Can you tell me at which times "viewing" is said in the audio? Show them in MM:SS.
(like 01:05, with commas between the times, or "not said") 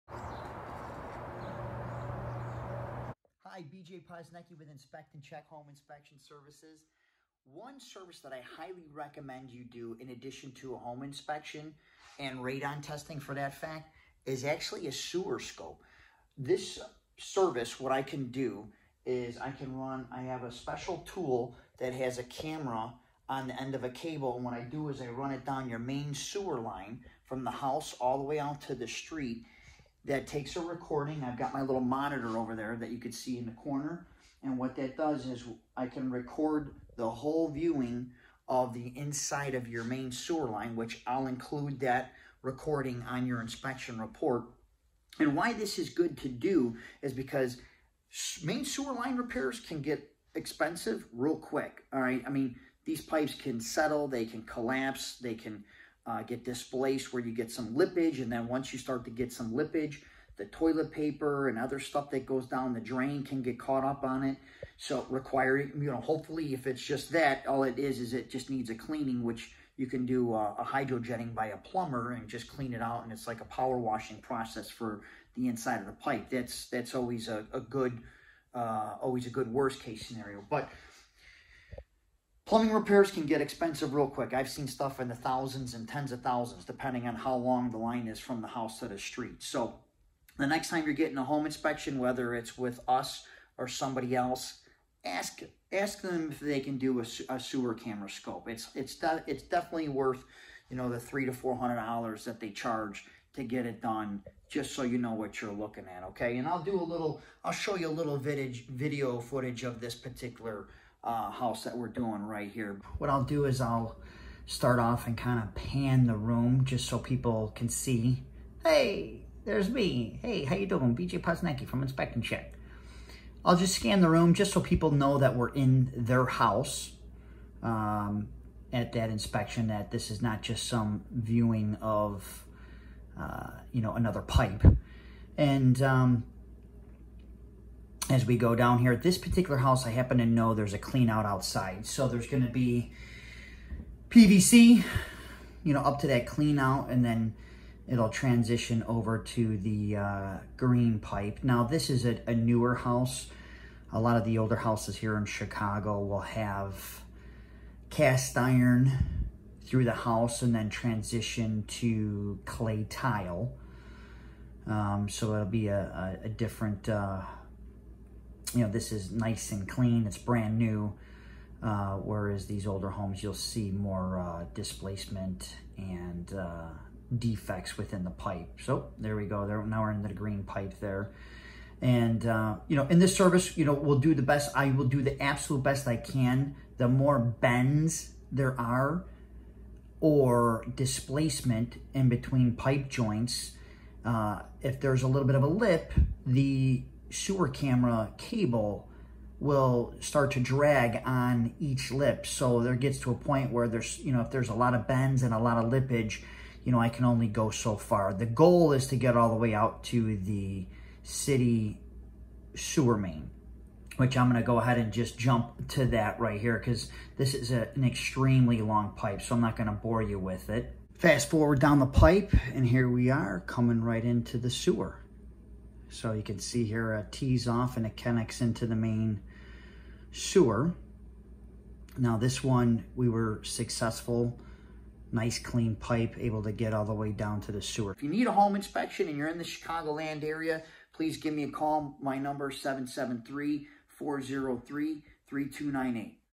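00:37, 02:11.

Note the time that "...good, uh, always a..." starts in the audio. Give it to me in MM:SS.
01:17.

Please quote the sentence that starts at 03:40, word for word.
Fast forward down the pipe, and here we are coming right into the sewer.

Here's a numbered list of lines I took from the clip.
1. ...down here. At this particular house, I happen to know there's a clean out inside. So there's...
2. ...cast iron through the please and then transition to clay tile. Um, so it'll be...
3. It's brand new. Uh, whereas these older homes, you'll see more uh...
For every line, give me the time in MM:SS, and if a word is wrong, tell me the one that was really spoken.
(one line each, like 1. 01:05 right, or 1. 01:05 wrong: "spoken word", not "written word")
1. 02:18 wrong: "outside", not "inside"
2. 02:37 wrong: "house", not "please"
3. 02:50 right.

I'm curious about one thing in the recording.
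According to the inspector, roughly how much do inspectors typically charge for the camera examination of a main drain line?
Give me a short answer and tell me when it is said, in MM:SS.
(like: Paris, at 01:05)
$300 to $400, at 01:40.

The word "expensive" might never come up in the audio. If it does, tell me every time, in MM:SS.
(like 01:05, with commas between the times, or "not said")
00:50, 01:23.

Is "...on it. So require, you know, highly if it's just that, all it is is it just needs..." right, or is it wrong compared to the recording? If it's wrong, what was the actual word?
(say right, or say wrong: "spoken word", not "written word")
wrong: "hopefully", not "highly".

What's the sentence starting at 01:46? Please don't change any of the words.
Okay, and I'll do a little.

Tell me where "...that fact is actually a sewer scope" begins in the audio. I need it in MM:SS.
00:13.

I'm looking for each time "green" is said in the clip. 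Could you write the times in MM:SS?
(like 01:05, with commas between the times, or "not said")
02:30, 03:00.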